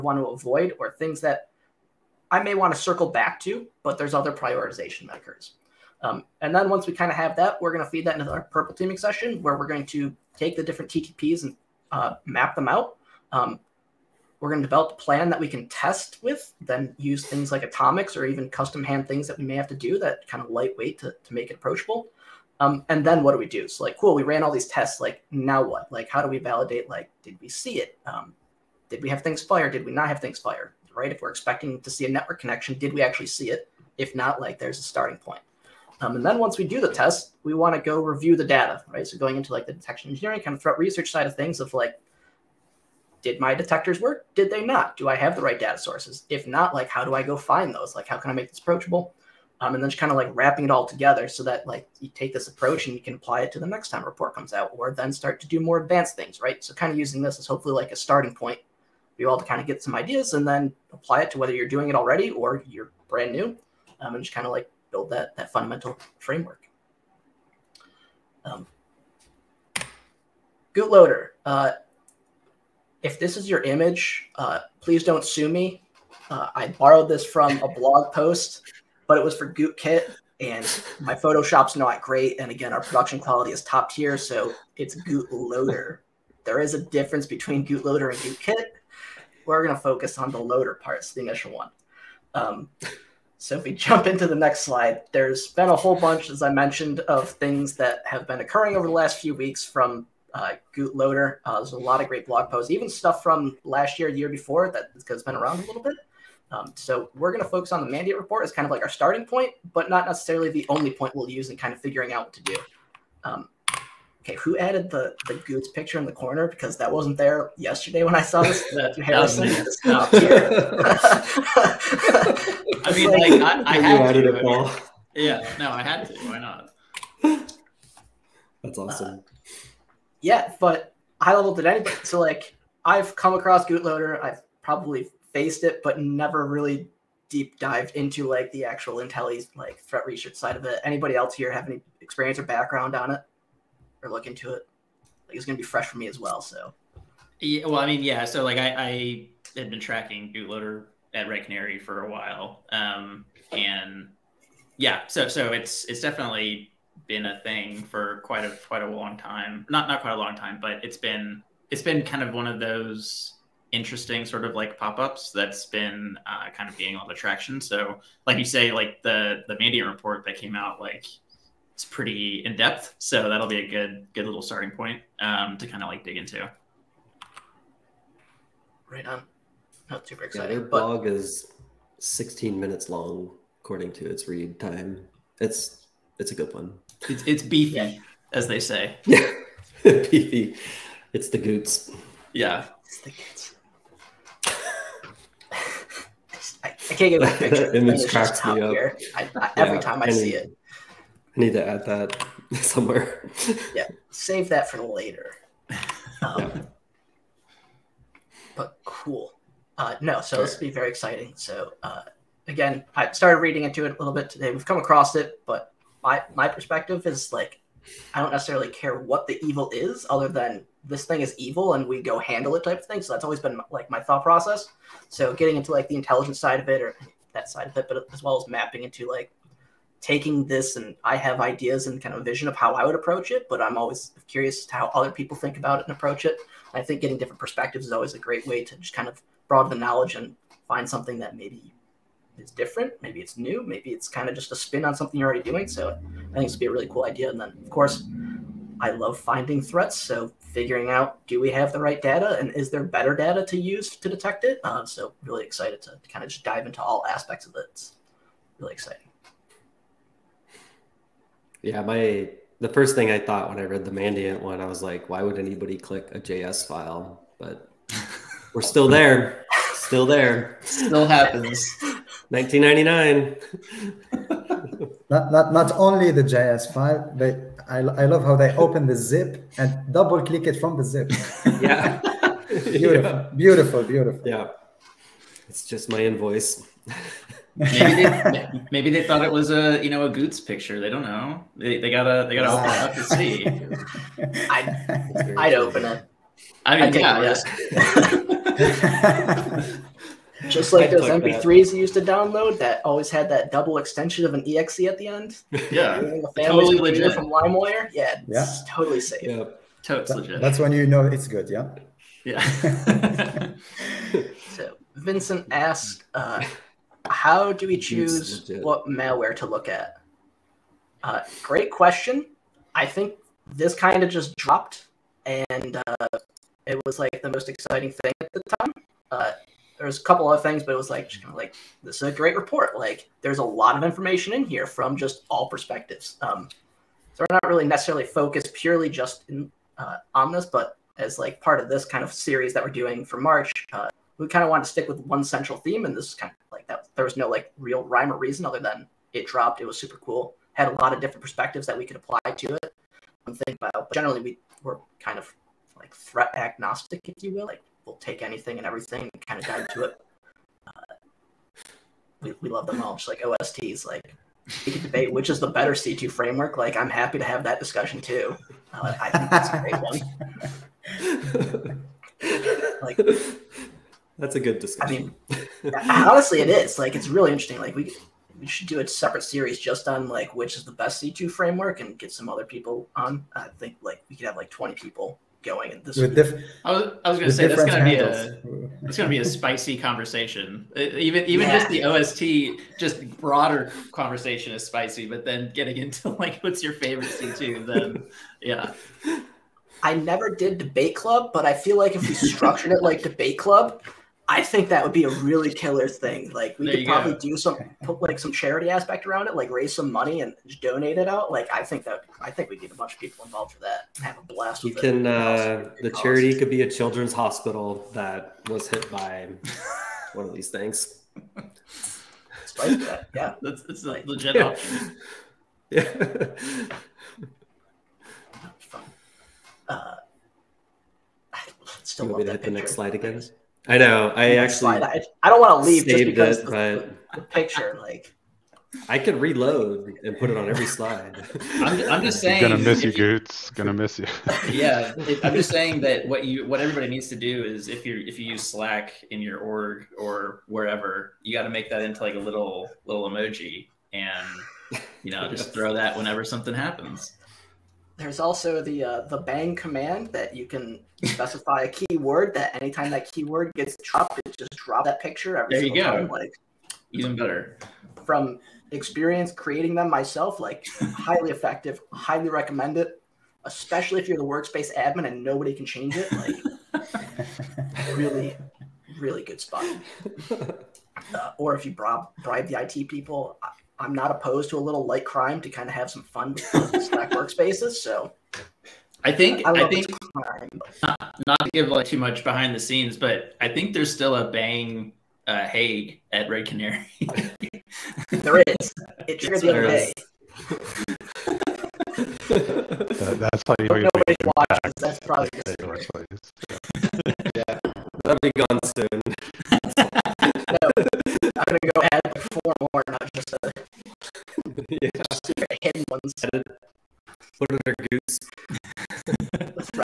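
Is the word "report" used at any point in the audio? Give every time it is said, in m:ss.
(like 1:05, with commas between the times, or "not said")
0:54, 1:48, 2:49, 5:32.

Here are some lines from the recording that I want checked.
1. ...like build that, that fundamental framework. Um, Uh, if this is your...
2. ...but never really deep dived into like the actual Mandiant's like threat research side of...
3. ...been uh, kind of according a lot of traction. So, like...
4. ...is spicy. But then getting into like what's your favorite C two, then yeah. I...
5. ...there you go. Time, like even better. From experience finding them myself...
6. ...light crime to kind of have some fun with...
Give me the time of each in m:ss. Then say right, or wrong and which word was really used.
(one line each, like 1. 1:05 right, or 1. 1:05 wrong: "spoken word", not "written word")
1. 1:04 right
2. 2:15 wrong: "Intelli", not "Mandiant"
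3. 2:45 wrong: "gaining", not "according"
4. 6:34 right
5. 7:45 wrong: "creating", not "finding"
6. 8:04 right.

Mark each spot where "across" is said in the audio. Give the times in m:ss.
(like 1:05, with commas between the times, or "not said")
2:13, 3:34.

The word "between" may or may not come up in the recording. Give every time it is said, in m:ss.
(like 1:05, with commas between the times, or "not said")
1:27.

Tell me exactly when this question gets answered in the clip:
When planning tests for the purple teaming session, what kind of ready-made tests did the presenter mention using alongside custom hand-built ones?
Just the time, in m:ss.
0:17.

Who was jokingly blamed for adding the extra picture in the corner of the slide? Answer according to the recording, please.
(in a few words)
Harrison.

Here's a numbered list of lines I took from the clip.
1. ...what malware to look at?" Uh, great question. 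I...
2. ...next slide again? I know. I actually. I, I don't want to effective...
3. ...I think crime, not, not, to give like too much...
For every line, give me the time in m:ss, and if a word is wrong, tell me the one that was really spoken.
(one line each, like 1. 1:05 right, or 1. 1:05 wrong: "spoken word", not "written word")
1. 5:18 right
2. 7:12 wrong: "leave", not "effective"
3. 8:09 right.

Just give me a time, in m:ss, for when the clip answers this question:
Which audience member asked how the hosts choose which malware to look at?
5:14.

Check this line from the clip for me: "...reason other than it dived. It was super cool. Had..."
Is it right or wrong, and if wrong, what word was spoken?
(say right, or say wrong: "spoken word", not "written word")
wrong: "dropped", not "dived".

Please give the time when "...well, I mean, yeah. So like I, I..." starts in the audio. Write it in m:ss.
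2:27.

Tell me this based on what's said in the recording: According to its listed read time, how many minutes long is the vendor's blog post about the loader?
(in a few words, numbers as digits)
16.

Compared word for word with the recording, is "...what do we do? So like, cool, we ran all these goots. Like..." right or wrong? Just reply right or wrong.
wrong.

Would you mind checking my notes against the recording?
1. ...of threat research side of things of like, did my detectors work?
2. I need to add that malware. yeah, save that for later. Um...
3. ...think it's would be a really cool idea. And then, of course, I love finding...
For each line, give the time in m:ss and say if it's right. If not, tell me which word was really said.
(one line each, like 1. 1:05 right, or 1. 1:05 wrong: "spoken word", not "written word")
1. 0:40 right
2. 3:21 wrong: "somewhere", not "malware"
3. 4:06 right.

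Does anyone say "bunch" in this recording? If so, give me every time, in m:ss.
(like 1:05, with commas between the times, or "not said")
1:35, 6:52.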